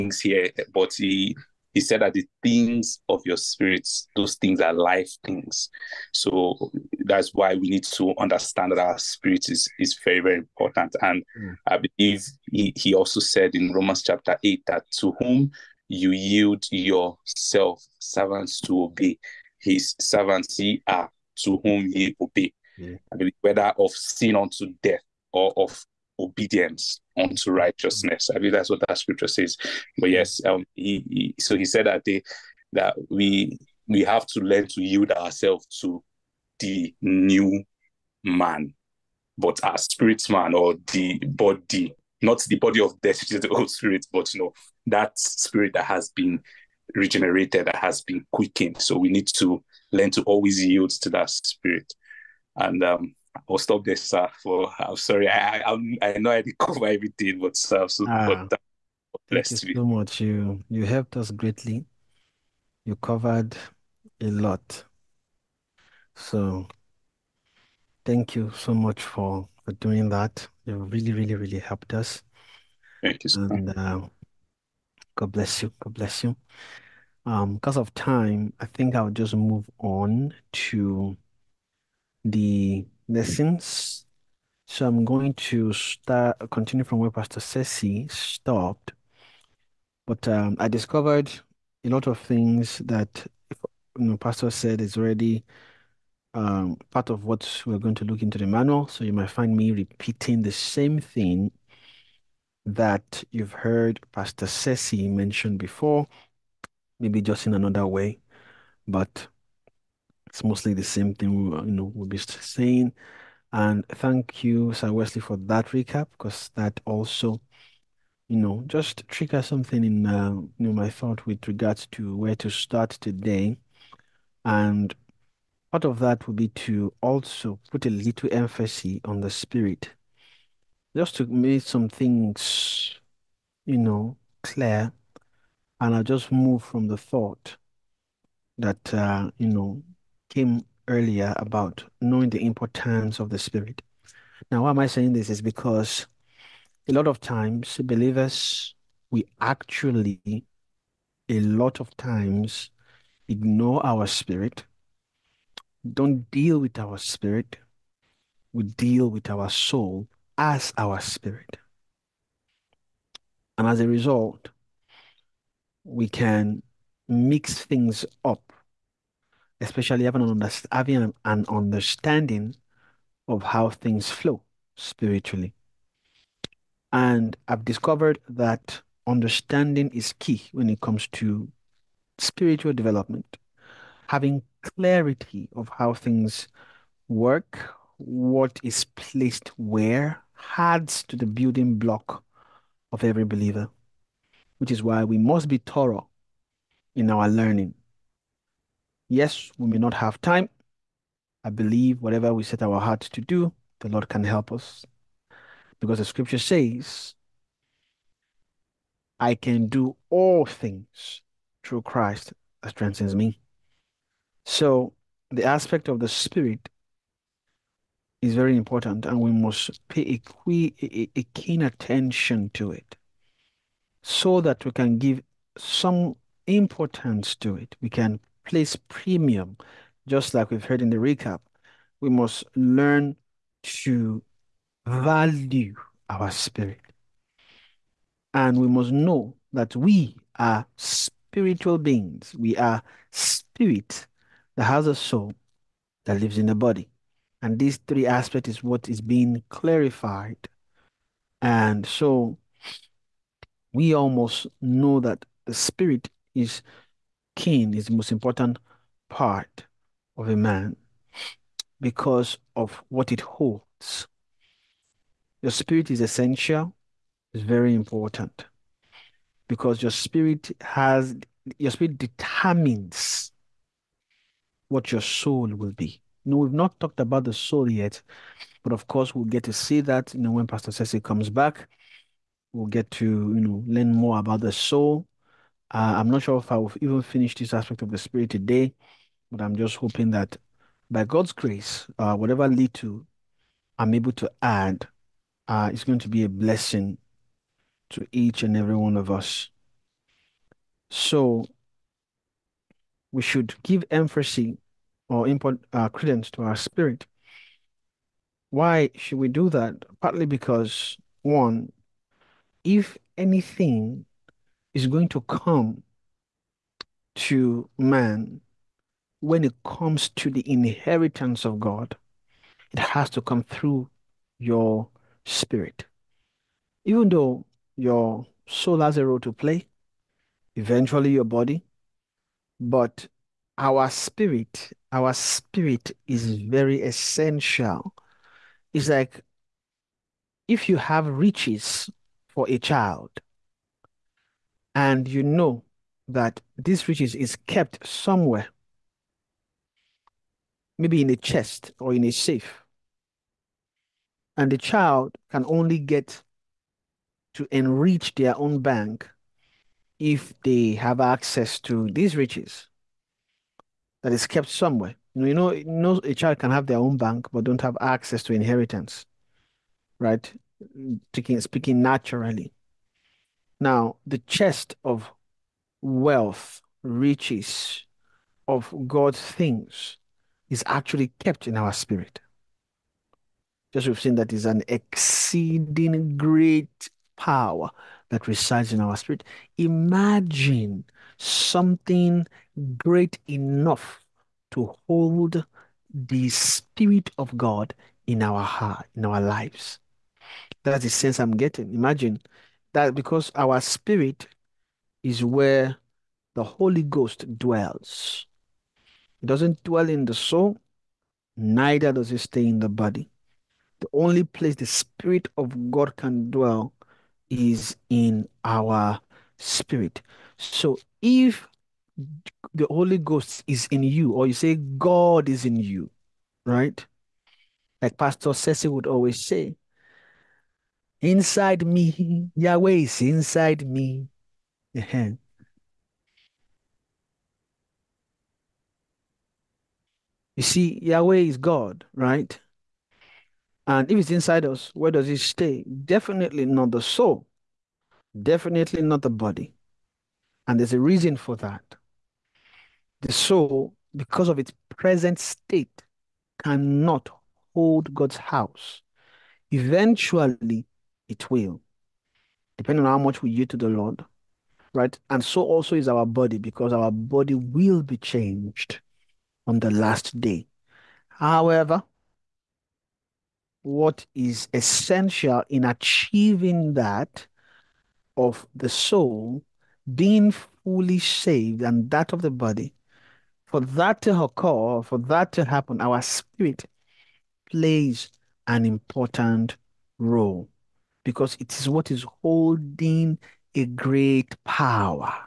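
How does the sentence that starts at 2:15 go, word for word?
And I just move from the thought that uh, you know came earlier about knowing the importance of the Spirit.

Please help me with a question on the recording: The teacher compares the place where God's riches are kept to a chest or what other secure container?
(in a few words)
A safe.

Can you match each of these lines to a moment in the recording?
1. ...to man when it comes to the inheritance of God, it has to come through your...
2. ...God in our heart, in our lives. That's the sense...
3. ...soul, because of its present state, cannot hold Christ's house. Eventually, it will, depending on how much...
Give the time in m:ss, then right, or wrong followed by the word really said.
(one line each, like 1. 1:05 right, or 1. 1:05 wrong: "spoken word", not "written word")
1. 5:17 right
2. 6:37 right
3. 7:33 wrong: "God", not "Christ".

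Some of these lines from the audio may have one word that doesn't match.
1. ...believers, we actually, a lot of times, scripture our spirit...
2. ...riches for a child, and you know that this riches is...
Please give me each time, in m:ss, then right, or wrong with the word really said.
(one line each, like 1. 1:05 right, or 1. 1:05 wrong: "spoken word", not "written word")
1. 2:27 wrong: "ignore", not "scripture"
2. 5:41 right.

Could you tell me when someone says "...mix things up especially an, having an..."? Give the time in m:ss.
2:47.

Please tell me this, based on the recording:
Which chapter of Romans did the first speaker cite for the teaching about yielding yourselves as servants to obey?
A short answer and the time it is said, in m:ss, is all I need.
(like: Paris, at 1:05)
Romans 8, at 0:13.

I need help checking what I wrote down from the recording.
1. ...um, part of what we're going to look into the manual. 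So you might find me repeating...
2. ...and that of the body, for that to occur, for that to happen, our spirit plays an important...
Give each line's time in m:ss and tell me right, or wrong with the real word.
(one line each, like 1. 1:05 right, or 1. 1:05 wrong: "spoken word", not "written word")
1. 1:36 right
2. 8:01 right.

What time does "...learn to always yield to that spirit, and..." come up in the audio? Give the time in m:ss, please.
0:49.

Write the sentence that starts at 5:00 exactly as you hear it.
So we should give emphasis or import uh, credence to our spirit.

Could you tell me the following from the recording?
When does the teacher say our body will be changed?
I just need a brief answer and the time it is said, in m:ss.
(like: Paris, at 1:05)
On the last day, at 7:49.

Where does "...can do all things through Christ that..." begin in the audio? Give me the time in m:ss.
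3:29.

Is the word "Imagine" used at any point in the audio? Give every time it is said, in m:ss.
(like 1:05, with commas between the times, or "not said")
6:29, 6:41.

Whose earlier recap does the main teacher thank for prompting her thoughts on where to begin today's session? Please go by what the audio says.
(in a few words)
Sir Wesley.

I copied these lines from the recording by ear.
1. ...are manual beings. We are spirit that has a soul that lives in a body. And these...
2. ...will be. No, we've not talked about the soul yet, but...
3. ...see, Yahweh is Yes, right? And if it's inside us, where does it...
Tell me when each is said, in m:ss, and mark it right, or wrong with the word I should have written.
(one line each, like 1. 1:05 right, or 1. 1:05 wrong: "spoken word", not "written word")
1. 4:00 wrong: "spiritual", not "manual"
2. 4:35 right
3. 7:20 wrong: "God", not "Yes".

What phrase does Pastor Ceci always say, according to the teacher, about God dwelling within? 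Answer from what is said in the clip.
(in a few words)
Yahweh is inside me.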